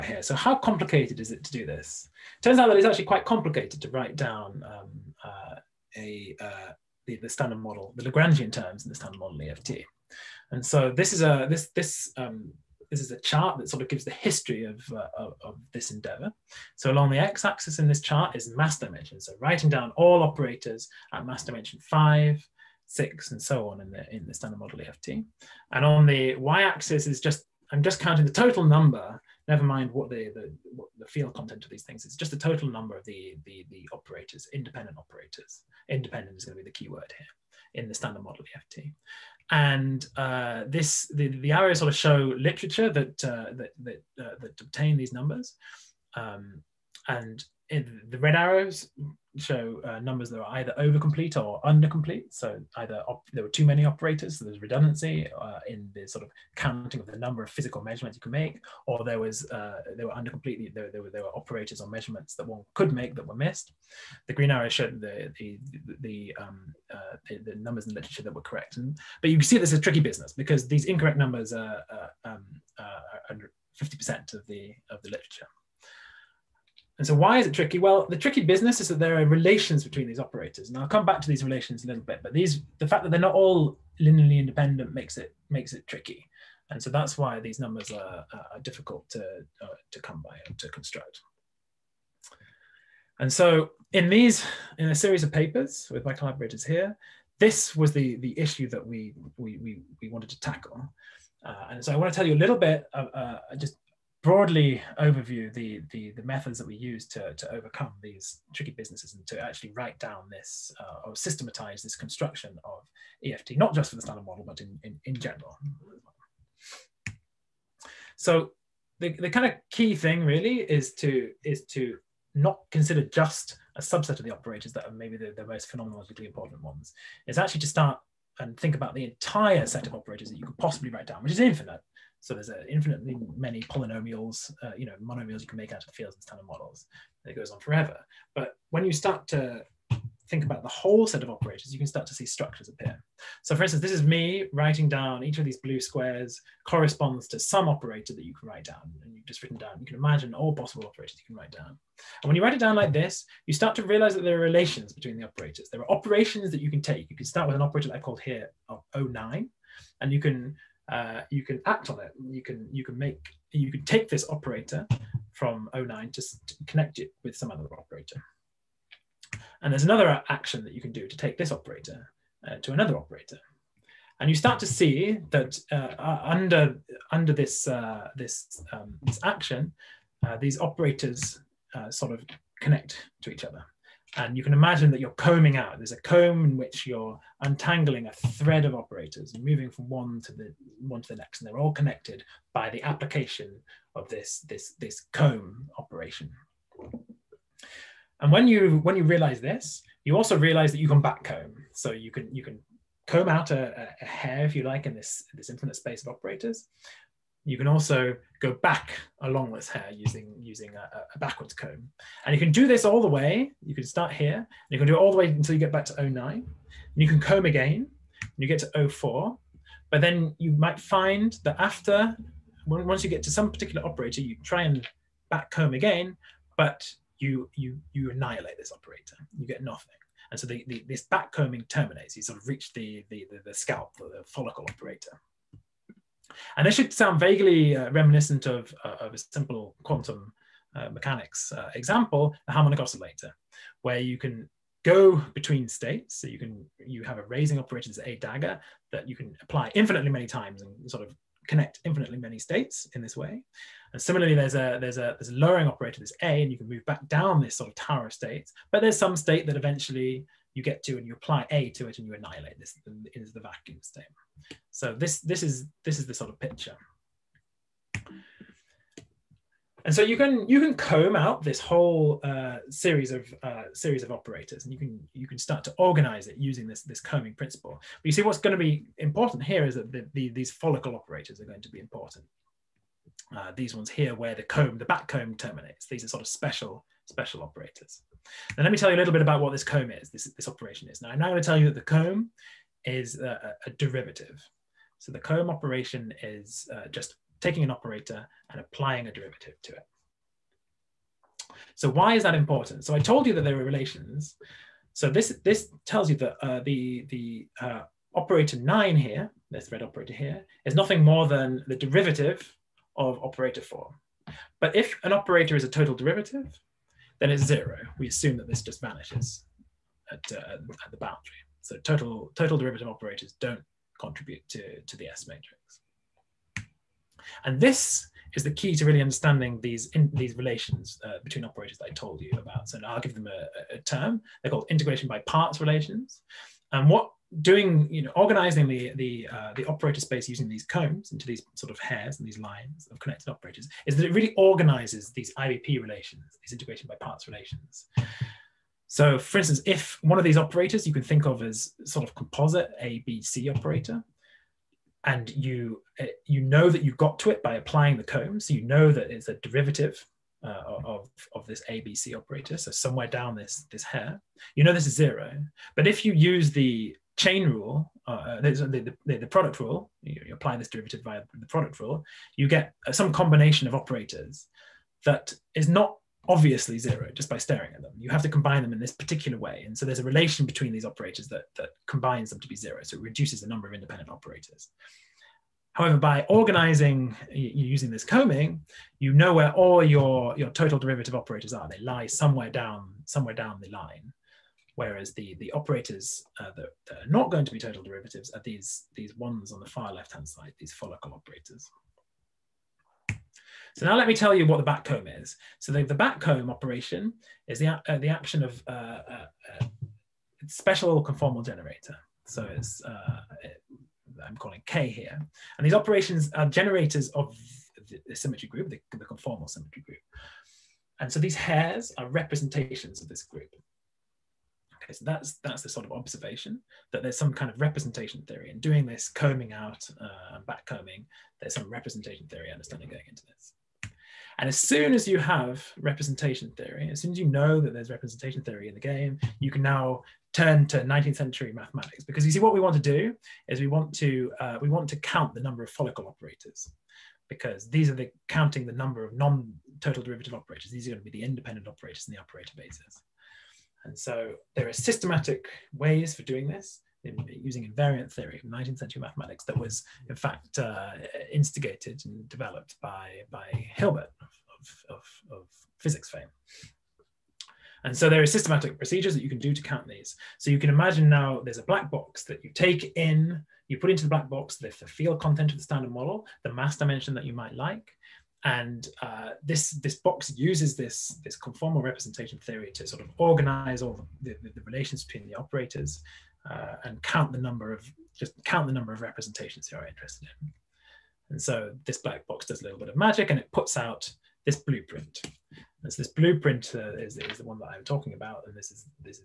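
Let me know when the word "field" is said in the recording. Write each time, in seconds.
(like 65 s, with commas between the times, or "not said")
31 s, 135 s, 474 s.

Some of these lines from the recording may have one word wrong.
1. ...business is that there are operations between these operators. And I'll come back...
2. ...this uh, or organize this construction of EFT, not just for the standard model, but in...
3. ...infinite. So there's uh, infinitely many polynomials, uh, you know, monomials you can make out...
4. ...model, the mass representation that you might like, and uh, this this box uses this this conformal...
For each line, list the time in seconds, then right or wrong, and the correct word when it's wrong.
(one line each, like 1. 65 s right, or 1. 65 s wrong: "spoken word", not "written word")
1. 78 s wrong: "relations", not "operations"
2. 110 s wrong: "systematize", not "organize"
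3. 131 s right
4. 475 s wrong: "dimension", not "representation".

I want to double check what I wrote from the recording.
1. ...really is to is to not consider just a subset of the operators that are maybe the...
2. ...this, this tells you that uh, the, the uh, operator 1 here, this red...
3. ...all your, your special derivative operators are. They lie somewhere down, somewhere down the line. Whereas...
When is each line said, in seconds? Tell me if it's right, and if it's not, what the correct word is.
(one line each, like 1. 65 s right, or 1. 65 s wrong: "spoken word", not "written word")
1. 120 s right
2. 305 s wrong: "9", not "1"
3. 389 s wrong: "total", not "special".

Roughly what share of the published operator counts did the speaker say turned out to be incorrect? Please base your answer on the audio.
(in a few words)
50%.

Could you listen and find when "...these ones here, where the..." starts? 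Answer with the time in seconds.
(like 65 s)
283 s.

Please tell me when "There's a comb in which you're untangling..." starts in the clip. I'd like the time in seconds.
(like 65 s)
185 s.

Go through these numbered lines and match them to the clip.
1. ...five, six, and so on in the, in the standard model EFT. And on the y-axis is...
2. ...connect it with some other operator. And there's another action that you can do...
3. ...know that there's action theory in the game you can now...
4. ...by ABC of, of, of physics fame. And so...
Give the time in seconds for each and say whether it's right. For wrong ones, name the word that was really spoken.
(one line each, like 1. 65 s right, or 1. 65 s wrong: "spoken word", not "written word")
1. 21 s right
2. 166 s right
3. 437 s wrong: "representation", not "action"
4. 463 s wrong: "Hilbert", not "ABC".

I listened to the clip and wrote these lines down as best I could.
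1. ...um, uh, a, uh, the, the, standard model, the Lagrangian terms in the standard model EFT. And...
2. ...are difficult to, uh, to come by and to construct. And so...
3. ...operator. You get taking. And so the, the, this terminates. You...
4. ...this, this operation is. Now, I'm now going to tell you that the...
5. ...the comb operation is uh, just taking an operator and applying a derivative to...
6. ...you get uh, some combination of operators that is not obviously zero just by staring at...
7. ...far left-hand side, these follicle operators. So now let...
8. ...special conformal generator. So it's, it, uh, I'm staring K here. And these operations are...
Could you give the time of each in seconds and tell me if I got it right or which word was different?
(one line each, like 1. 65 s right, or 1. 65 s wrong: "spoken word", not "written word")
1. 4 s right
2. 88 s right
3. 228 s wrong: "nothing", not "taking"
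4. 290 s right
5. 295 s right
6. 372 s right
7. 399 s right
8. 410 s wrong: "calling", not "staring".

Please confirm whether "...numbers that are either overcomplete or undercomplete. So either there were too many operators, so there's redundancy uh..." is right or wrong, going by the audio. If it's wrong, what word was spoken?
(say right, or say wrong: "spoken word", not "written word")
right.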